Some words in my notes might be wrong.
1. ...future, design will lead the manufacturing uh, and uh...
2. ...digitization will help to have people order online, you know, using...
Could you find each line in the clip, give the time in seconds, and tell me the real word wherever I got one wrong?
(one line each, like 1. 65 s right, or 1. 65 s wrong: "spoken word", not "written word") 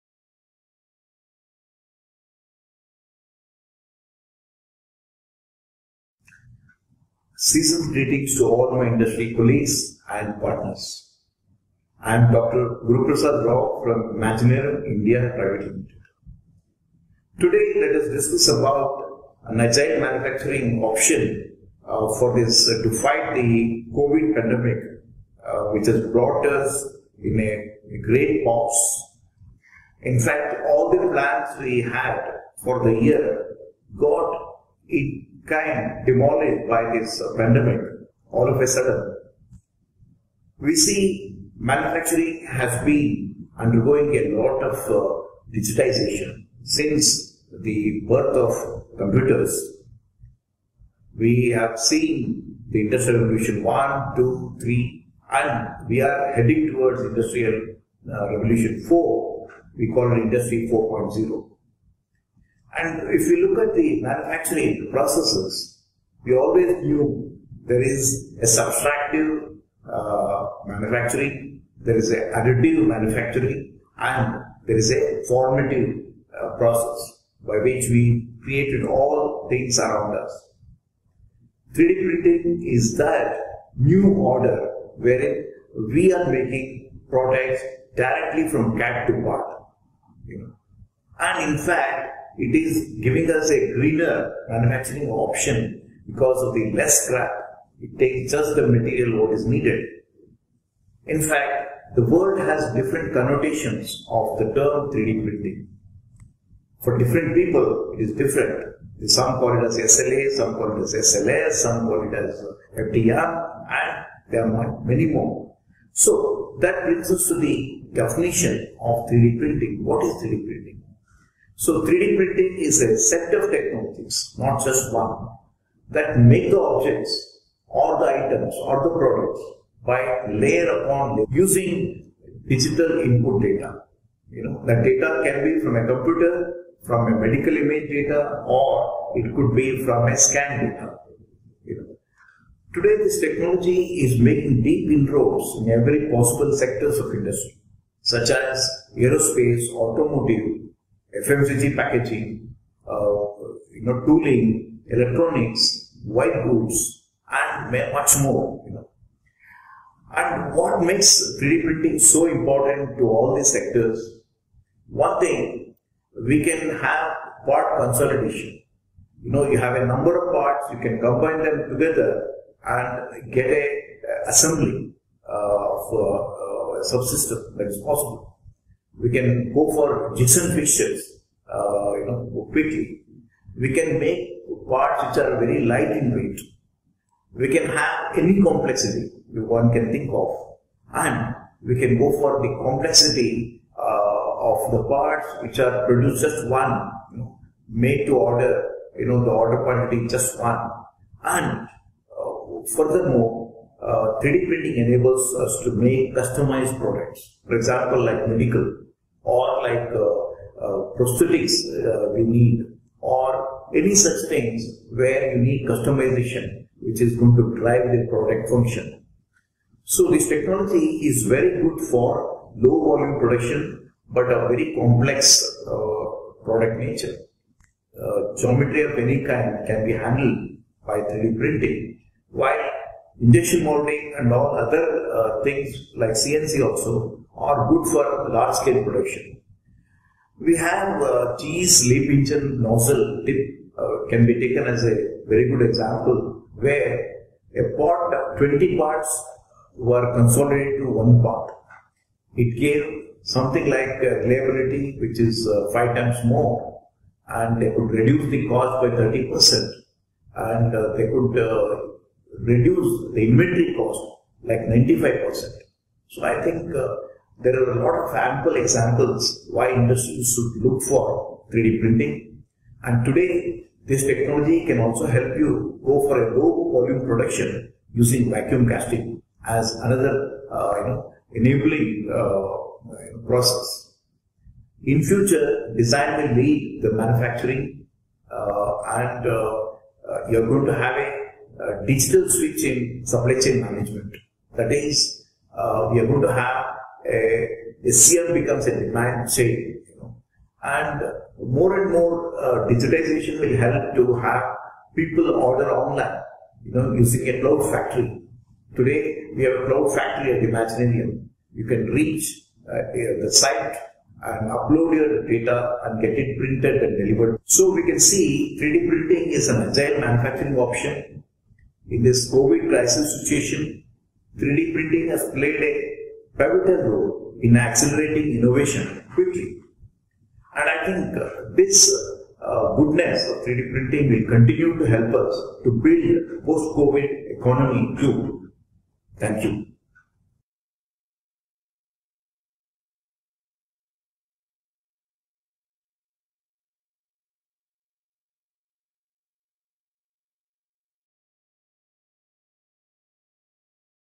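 1. 285 s right
2. 302 s right.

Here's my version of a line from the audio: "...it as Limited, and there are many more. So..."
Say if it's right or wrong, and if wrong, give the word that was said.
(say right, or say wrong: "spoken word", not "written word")
wrong: "FDR", not "Limited".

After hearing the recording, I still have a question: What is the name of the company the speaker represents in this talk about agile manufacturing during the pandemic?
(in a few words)
Imaginarium India Private Limited.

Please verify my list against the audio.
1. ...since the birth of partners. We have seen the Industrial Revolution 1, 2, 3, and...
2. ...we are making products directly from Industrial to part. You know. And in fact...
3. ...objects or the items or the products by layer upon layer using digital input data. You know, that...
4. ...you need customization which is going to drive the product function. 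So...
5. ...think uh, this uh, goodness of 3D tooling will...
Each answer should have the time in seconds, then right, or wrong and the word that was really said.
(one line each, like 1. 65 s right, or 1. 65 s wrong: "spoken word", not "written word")
1. 46 s wrong: "computers", not "partners"
2. 85 s wrong: "CAD", not "Industrial"
3. 126 s right
4. 215 s right
5. 330 s wrong: "printing", not "tooling".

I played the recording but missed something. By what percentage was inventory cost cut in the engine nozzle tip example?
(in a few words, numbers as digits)
95%.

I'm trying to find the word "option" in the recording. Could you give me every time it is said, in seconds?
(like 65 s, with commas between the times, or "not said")
20 s, 95 s, 320 s.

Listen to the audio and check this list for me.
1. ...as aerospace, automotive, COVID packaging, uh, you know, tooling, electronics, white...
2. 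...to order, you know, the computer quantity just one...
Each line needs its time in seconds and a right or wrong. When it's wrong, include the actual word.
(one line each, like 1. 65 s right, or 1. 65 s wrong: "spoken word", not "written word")
1. 148 s wrong: "FMCG", not "COVID"
2. 198 s wrong: "order", not "computer".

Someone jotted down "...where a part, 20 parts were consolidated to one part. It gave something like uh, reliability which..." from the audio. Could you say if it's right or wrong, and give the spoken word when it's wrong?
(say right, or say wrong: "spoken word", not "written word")
right.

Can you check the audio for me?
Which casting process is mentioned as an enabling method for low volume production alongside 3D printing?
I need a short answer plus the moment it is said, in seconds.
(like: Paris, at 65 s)
Vacuum casting, at 278 s.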